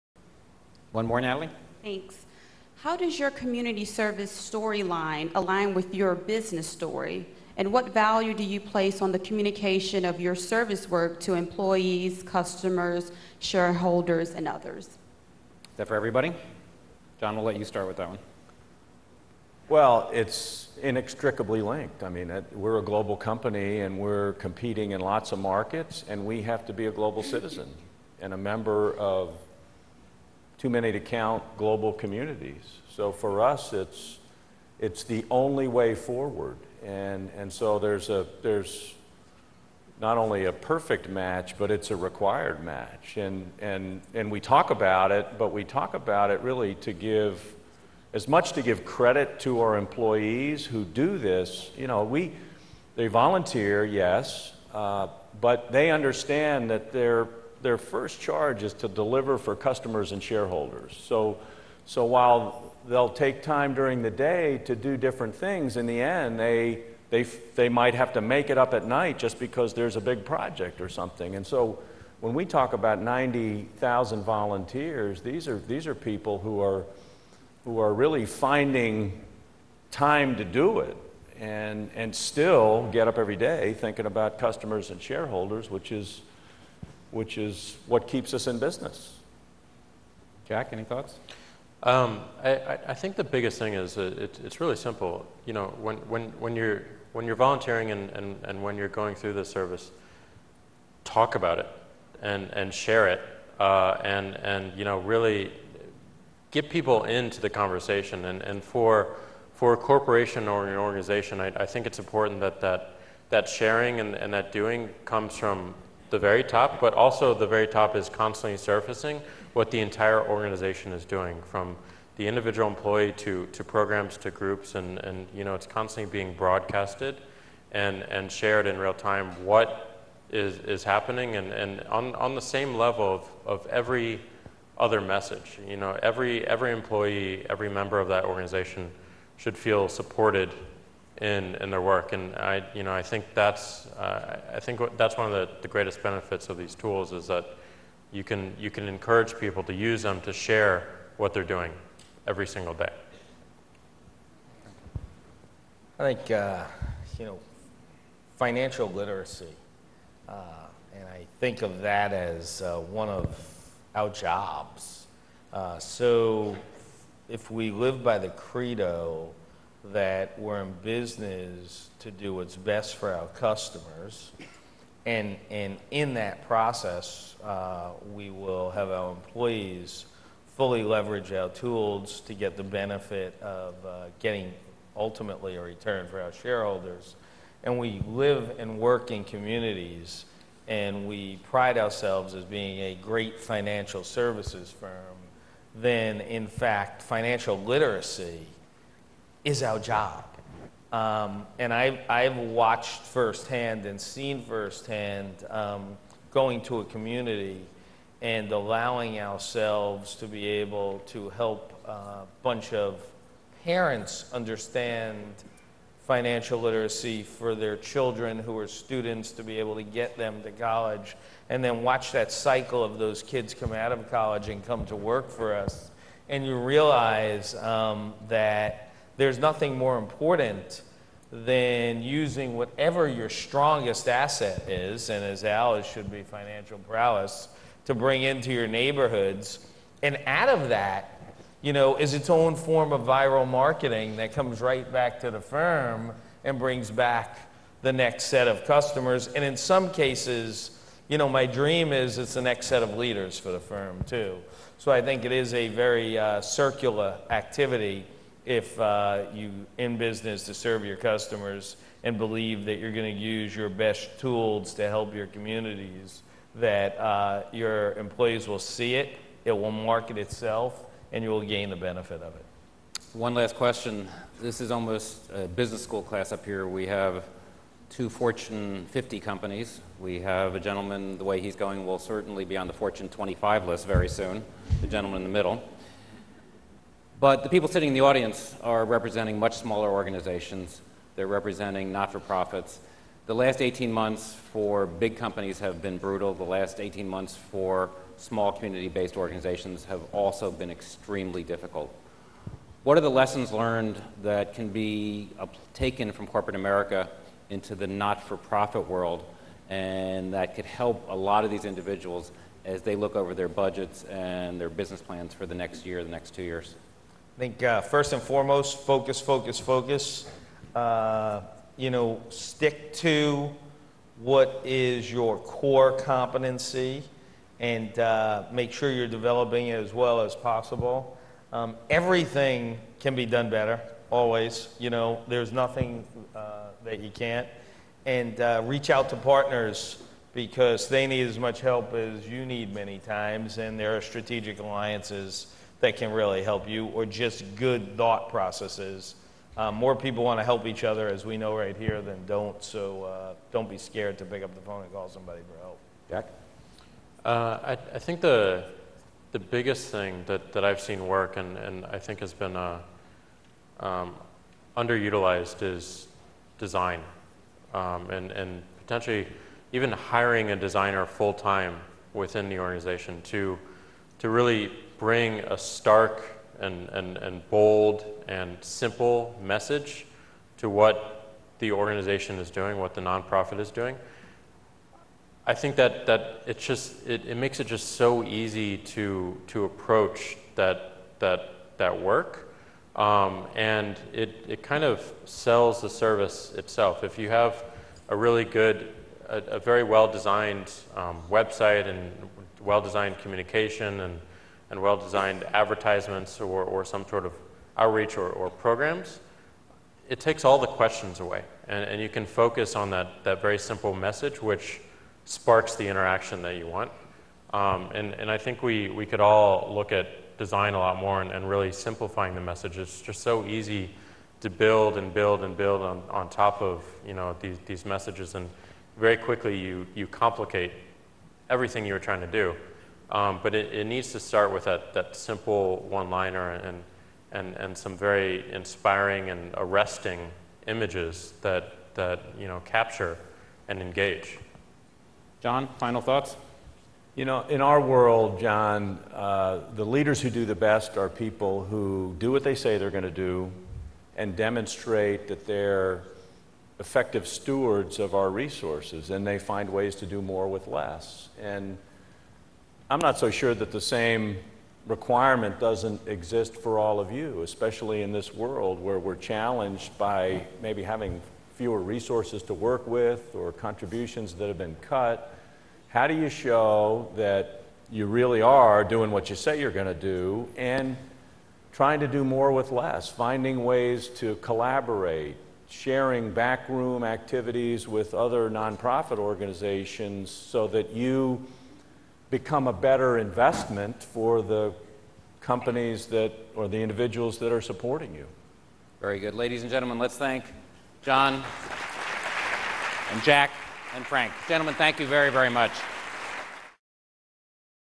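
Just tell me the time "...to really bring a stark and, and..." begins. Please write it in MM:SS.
06:14.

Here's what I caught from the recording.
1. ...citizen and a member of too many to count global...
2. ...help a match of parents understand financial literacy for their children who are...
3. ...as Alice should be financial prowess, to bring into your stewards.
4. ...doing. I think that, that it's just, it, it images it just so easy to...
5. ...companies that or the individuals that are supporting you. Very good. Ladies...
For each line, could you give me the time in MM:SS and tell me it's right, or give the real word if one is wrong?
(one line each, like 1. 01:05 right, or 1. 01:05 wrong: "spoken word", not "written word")
1. 00:27 right
2. 03:31 wrong: "bunch", not "match"
3. 03:55 wrong: "neighborhoods", not "stewards"
4. 06:23 wrong: "makes", not "images"
5. 08:15 right.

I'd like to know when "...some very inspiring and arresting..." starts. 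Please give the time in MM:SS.
07:17.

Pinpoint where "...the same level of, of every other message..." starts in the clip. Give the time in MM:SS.
02:12.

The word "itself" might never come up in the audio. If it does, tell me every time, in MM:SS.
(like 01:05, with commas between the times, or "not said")
04:30, 06:36.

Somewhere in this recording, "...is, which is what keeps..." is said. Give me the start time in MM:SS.
01:25.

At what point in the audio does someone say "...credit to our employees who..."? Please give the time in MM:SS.
00:48.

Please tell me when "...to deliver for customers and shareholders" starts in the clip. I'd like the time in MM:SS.
00:58.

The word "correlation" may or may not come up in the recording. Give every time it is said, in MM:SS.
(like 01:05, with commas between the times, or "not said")
not said.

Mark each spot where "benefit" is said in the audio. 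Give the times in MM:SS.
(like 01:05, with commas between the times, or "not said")
02:26, 03:02, 04:31.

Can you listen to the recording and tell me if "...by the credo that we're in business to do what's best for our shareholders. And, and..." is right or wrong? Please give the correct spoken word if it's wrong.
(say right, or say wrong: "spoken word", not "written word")
wrong: "customers", not "shareholders".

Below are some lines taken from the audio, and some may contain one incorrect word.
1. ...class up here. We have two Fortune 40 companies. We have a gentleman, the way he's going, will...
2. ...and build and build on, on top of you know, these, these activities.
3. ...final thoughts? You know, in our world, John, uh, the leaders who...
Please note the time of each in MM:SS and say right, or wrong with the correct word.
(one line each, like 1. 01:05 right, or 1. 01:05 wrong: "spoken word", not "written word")
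1. 04:36 wrong: "50", not "40"
2. 07:04 wrong: "messages", not "activities"
3. 07:25 right.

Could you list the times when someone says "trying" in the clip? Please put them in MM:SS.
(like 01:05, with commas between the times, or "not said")
07:11, 08:01.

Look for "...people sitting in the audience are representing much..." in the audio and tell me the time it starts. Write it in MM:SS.
04:47.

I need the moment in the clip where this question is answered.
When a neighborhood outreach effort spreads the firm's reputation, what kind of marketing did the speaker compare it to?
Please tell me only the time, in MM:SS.
04:03.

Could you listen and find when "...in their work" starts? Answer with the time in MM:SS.
02:21.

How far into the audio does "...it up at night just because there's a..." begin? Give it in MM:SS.
01:08.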